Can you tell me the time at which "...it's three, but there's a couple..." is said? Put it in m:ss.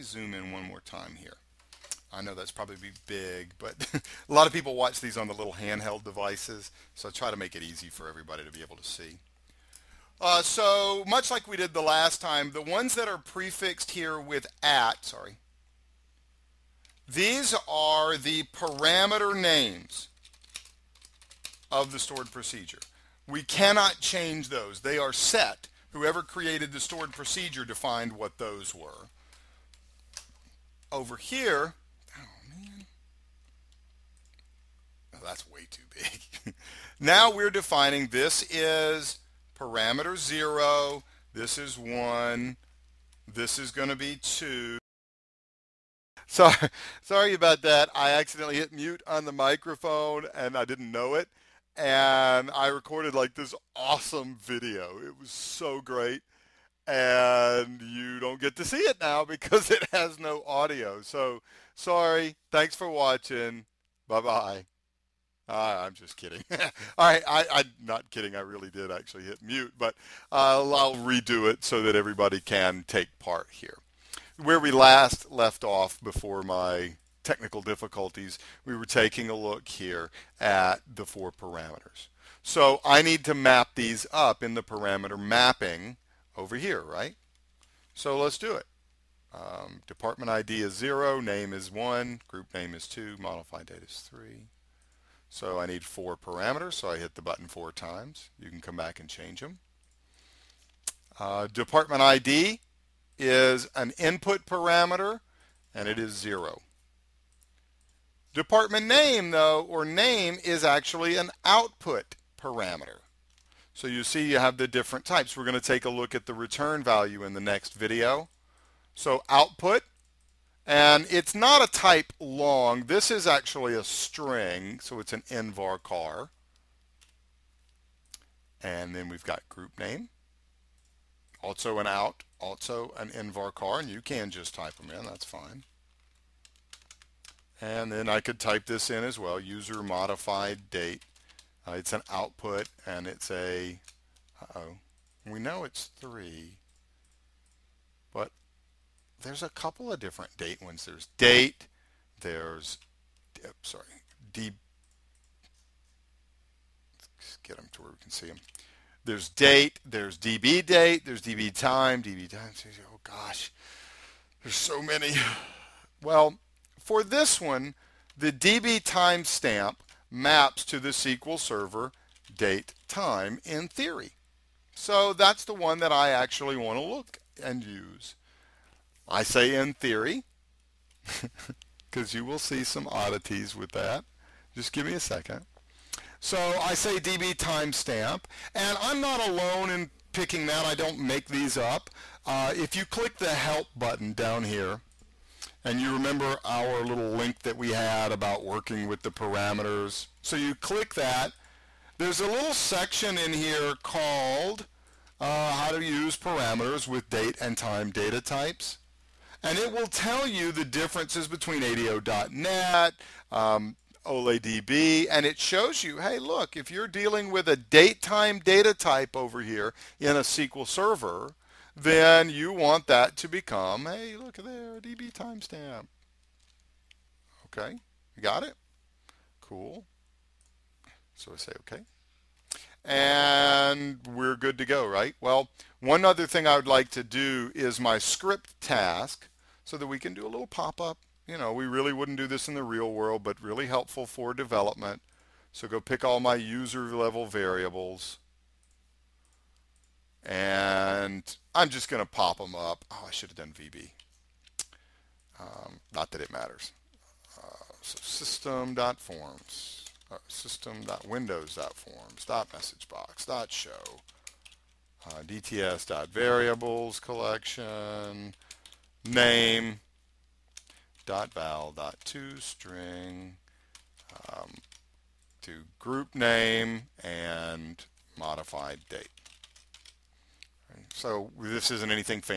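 2:25.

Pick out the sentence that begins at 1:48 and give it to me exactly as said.
Department name, though, or name is actually an output parameter.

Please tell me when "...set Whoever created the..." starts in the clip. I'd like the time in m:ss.
0:25.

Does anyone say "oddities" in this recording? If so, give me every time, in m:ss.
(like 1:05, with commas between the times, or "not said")
3:02.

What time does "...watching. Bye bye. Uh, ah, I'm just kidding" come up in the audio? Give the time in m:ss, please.
1:02.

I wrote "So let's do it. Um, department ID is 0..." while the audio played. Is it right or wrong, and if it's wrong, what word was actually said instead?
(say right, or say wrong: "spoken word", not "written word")
right.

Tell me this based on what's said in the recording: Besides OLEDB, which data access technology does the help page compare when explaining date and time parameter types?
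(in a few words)
ADO.NET.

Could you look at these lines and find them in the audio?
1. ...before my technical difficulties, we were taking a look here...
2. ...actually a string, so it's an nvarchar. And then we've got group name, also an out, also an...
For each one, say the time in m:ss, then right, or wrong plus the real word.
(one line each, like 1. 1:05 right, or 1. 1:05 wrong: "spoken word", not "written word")
1. 1:16 right
2. 2:03 right.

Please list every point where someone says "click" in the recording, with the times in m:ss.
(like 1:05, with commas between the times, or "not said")
3:12, 3:20.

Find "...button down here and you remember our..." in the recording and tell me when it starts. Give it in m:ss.
3:13.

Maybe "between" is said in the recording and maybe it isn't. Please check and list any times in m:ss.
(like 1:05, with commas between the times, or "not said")
3:31.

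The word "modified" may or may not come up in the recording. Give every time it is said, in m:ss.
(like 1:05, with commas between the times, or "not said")
1:33, 2:19, 4:38.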